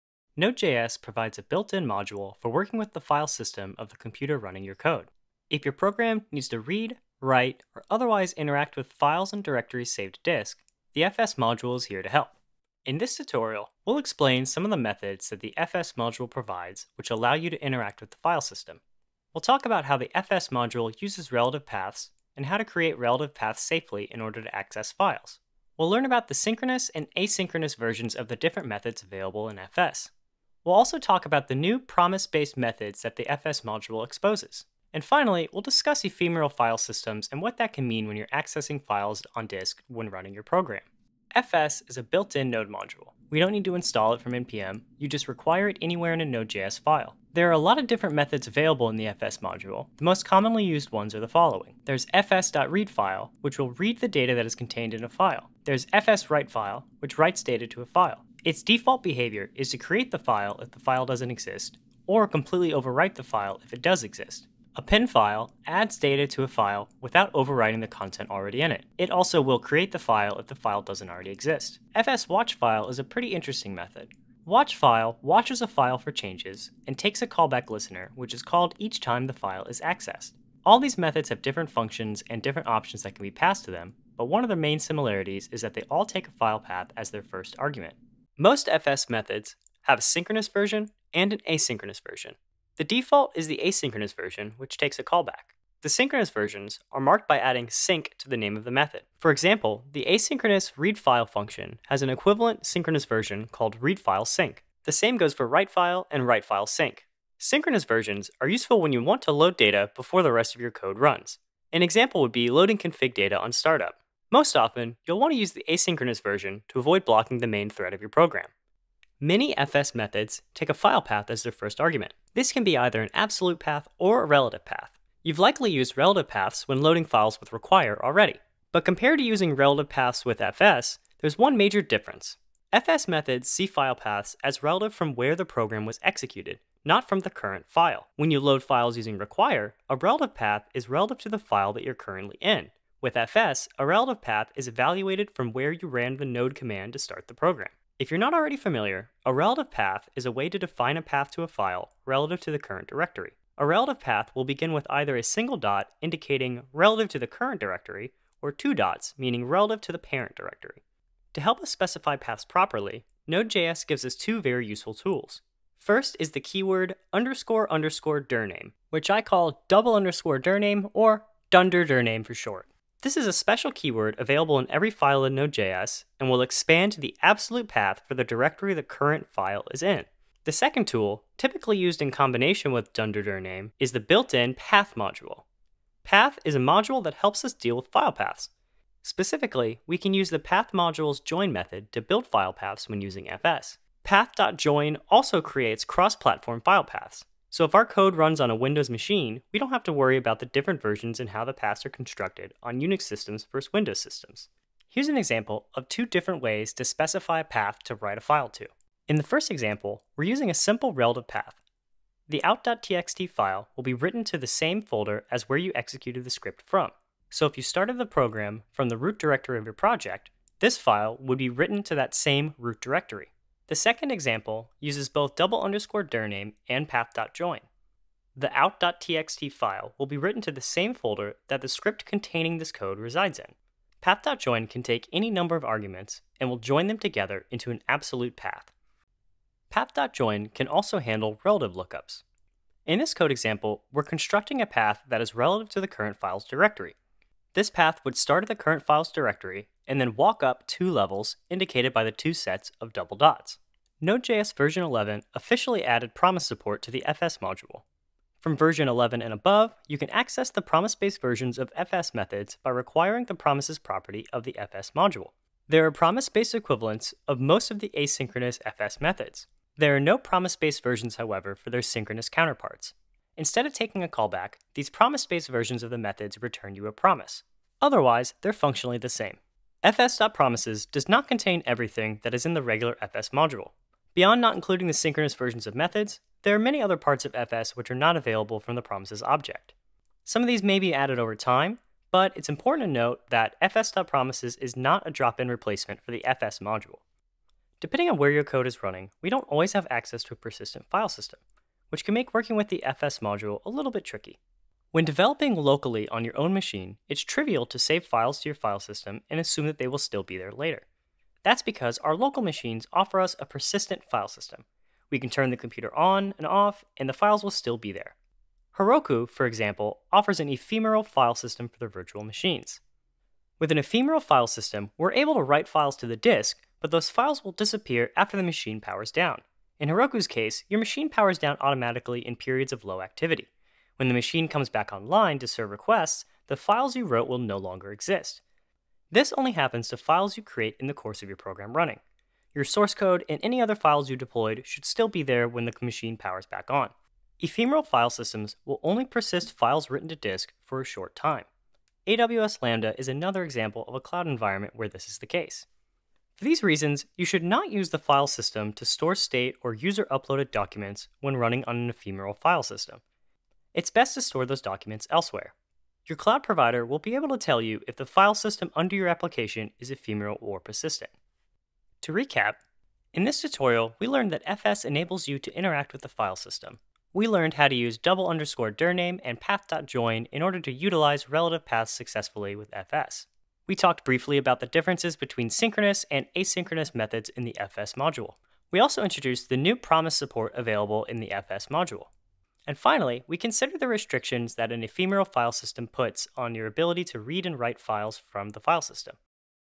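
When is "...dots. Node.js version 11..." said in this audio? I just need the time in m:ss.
4:13.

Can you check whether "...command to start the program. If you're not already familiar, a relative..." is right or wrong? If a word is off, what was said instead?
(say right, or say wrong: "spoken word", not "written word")
right.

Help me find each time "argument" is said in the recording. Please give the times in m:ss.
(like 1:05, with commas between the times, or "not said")
1:27, 2:01, 3:55.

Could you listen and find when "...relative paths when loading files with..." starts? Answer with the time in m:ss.
2:05.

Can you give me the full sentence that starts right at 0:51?
There's fs.readFile, which will read the data that is contained in a file.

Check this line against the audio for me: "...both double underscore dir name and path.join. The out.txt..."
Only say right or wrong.
right.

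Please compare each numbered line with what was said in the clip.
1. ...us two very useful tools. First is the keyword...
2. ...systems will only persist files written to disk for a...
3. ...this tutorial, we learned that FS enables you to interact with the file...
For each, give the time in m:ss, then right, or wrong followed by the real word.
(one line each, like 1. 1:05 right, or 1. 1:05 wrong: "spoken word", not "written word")
1. 2:44 right
2. 5:48 right
3. 6:13 right.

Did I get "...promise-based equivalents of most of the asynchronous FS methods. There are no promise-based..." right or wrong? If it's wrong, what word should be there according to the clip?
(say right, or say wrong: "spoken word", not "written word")
right.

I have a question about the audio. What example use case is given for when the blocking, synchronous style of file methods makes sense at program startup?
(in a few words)
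loading config data.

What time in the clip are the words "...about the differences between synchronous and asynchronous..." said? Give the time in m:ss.
6:24.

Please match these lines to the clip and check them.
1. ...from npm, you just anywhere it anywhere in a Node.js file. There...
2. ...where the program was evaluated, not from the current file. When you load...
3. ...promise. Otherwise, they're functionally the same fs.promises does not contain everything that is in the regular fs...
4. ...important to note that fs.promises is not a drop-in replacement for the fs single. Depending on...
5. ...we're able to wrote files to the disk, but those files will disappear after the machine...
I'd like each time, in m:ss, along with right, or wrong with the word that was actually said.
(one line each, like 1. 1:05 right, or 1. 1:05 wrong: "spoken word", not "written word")
1. 0:44 wrong: "require", not "anywhere"
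2. 2:15 wrong: "executed", not "evaluated"
3. 4:36 right
4. 4:52 wrong: "module", not "single"
5. 5:24 wrong: "write", not "wrote".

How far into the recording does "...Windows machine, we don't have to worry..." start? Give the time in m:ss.
3:18.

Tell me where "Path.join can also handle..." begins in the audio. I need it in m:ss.
3:59.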